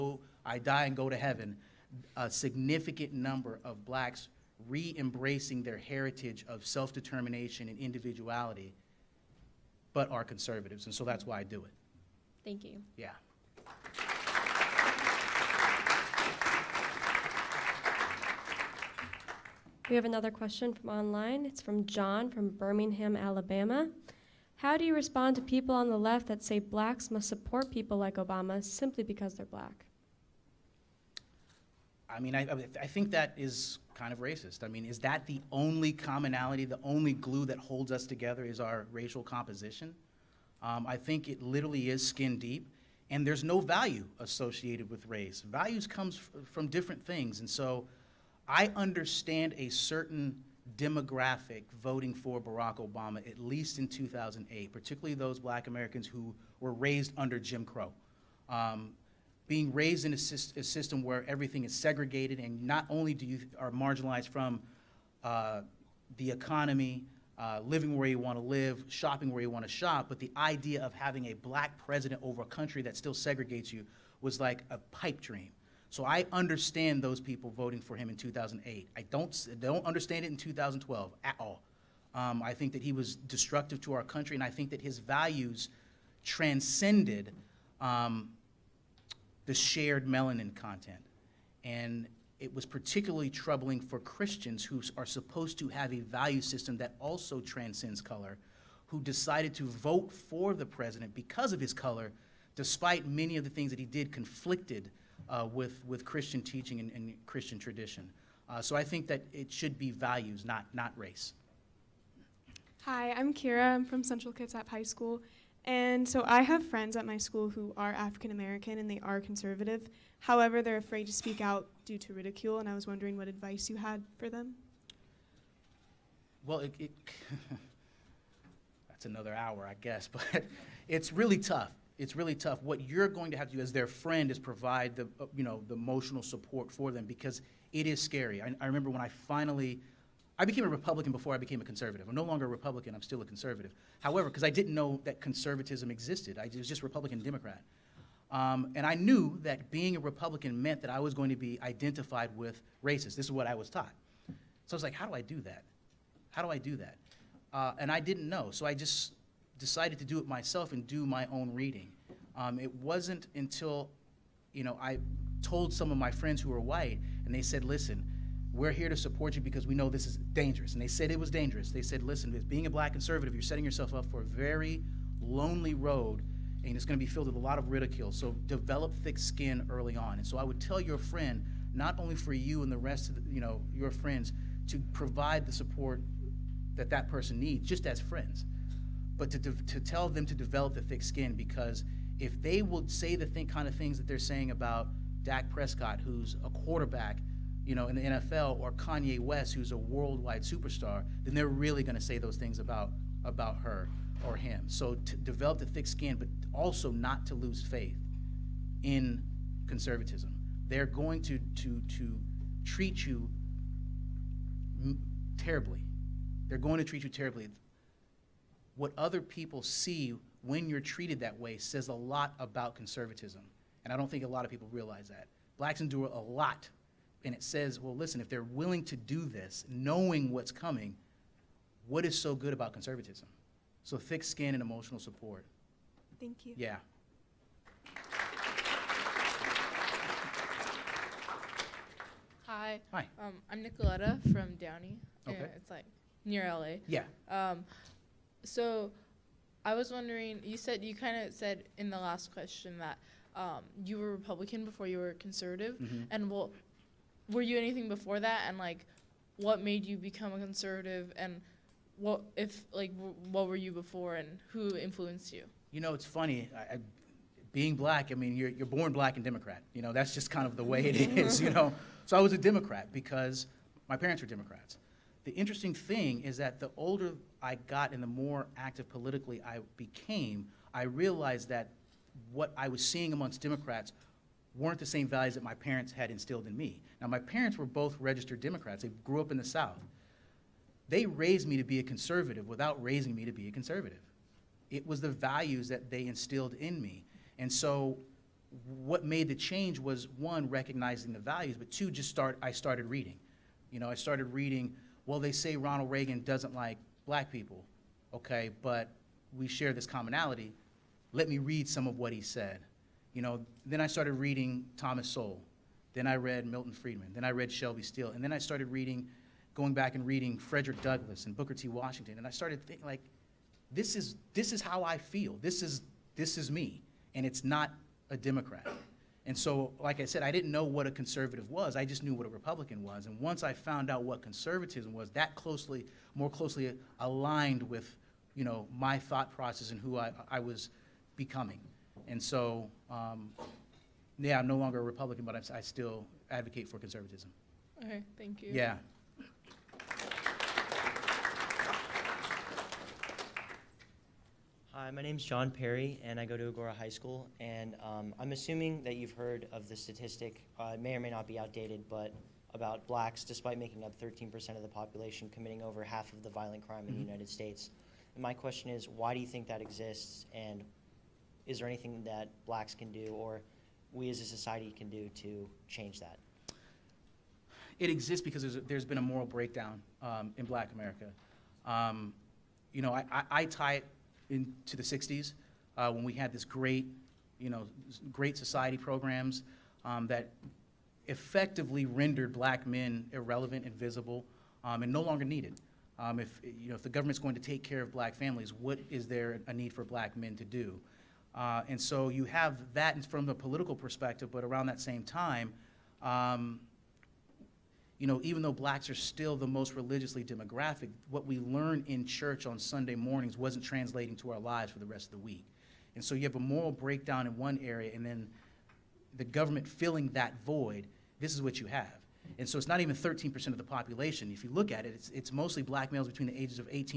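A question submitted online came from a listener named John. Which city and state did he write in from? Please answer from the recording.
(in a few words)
Birmingham, Alabama.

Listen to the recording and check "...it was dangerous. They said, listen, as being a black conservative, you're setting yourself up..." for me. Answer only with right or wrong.
right.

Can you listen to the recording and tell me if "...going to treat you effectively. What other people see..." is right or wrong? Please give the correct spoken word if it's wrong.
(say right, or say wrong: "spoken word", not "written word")
wrong: "terribly", not "effectively".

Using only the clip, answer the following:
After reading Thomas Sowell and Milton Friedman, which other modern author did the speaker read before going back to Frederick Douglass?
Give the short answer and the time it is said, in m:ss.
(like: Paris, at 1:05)
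Shelby Steele, at 5:17.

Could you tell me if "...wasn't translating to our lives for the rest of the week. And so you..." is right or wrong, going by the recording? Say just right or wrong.
right.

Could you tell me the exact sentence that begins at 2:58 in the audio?
So develop thick skin early on.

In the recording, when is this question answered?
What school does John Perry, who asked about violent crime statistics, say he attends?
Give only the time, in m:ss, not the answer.
5:56.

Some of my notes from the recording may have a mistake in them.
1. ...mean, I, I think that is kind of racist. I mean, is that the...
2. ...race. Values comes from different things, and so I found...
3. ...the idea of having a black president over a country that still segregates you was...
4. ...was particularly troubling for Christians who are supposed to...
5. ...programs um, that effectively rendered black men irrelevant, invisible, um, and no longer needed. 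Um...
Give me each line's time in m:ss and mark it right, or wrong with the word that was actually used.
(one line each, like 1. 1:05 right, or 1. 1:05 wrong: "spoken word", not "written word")
1. 0:32 right
2. 0:45 wrong: "understand", not "found"
3. 1:10 right
4. 1:32 right
5. 6:28 right.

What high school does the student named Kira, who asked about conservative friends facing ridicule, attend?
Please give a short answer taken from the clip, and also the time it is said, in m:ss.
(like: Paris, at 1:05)
Central Kitsap High School, at 1:54.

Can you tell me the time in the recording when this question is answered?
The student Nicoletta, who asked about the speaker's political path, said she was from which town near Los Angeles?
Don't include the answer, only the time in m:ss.
4:04.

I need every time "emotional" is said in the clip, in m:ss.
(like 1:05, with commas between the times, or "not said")
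2:15, 3:54.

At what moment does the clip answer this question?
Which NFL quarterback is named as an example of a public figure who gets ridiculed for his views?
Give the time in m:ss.
3:15.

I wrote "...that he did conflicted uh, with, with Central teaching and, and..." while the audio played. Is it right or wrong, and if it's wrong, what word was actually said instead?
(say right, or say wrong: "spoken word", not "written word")
wrong: "Christian", not "Central".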